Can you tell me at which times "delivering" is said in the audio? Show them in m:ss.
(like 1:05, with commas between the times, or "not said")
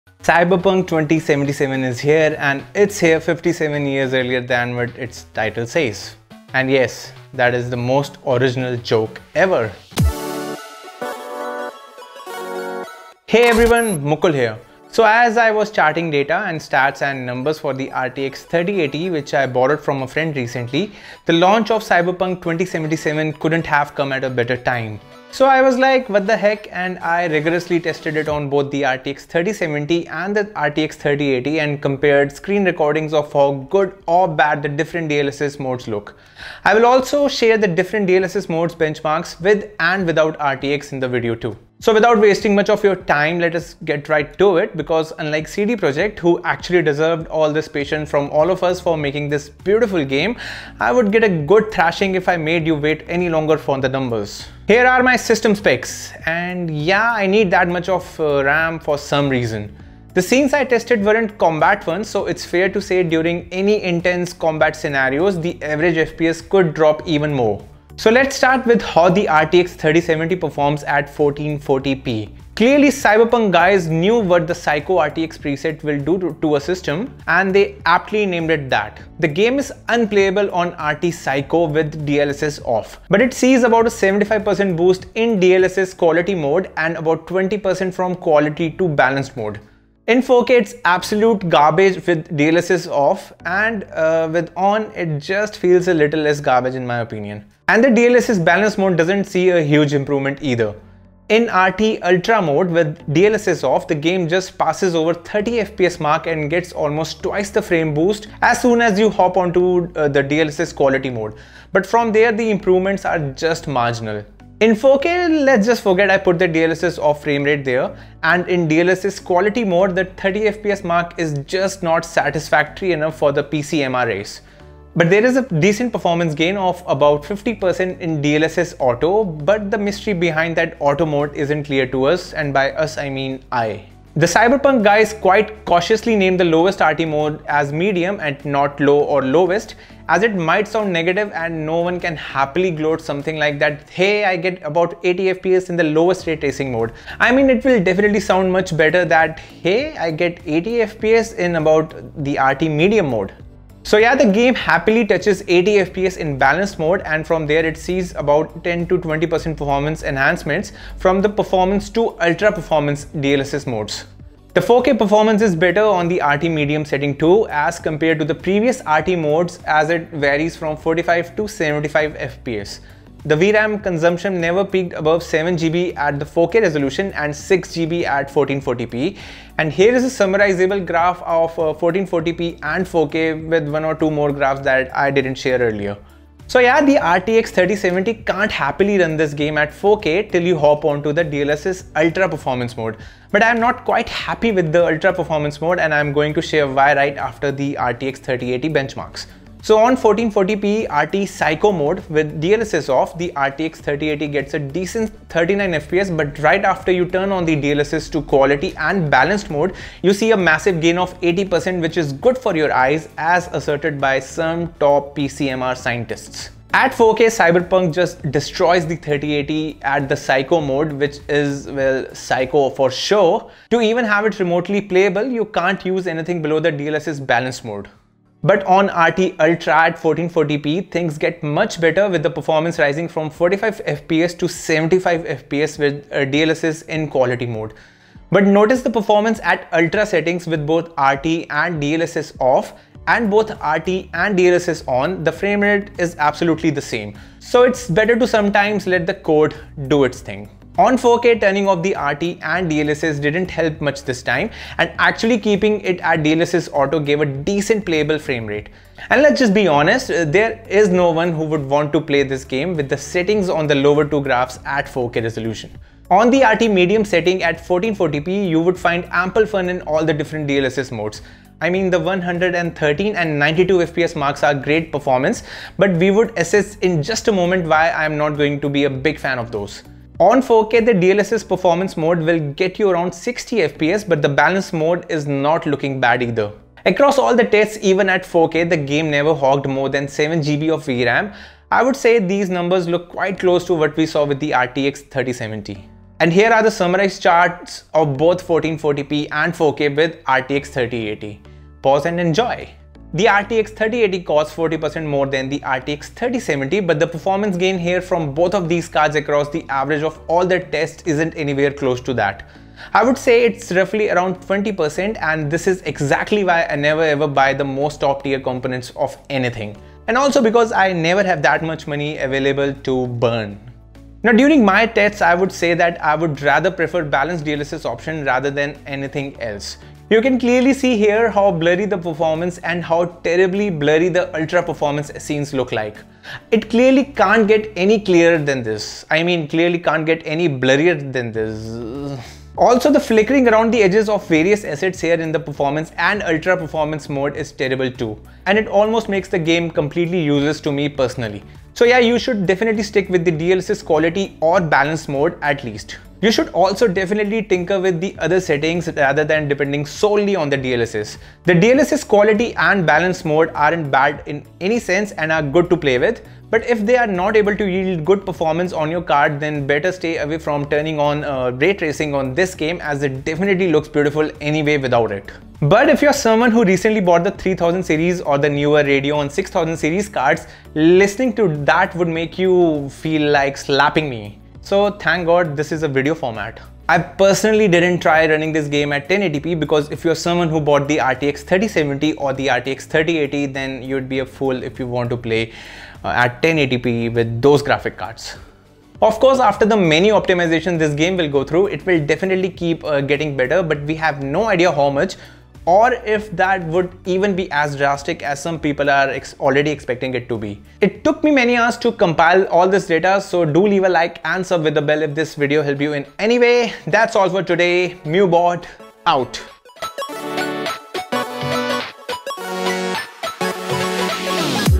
not said.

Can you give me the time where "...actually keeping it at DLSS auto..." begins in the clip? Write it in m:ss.
4:14.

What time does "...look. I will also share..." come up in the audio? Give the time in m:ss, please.
0:35.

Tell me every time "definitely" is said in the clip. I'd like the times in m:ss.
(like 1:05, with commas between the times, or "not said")
2:27, 5:52, 5:56, 6:13, 6:42.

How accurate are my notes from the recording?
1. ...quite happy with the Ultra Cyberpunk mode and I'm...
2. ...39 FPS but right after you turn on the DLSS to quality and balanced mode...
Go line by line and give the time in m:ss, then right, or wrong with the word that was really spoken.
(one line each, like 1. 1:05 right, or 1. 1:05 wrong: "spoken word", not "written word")
1. 3:13 wrong: "Performance", not "Cyberpunk"
2. 3:25 right.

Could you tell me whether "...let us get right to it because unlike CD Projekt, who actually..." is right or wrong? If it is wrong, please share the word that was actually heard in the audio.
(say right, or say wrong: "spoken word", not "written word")
right.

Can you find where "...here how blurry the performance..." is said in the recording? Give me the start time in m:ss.
5:30.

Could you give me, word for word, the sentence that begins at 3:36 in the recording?
At 4K, Cyberpunk just destroys the 3080 at the Psycho mode, which is, well, Psycho for sure.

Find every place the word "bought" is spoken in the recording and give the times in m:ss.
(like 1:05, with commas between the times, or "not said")
6:17, 6:30.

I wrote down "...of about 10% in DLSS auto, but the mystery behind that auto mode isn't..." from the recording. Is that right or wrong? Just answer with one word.
wrong.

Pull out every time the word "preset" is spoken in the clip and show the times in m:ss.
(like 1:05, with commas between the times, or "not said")
1:15.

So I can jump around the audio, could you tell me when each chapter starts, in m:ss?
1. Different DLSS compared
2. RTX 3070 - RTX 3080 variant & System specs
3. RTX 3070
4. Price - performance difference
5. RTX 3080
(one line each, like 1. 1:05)
1. 5:24
2. 0:25
3. 1:07
4. 5:03
5. 3:05.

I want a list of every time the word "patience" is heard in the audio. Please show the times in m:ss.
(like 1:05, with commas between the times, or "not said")
0:47.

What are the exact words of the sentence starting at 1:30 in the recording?
In 4K, it's absolute garbage with DLSS off and uh, with on, it just feels a little less garbage in my opinion.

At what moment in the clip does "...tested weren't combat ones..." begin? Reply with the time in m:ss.
1:00.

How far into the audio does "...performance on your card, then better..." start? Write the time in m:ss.
6:08.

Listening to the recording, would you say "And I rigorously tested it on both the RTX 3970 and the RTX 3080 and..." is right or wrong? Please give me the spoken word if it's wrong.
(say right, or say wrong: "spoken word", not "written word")
wrong: "3070", not "3970".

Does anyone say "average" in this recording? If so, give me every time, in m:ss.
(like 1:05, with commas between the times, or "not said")
1:05, 5:09.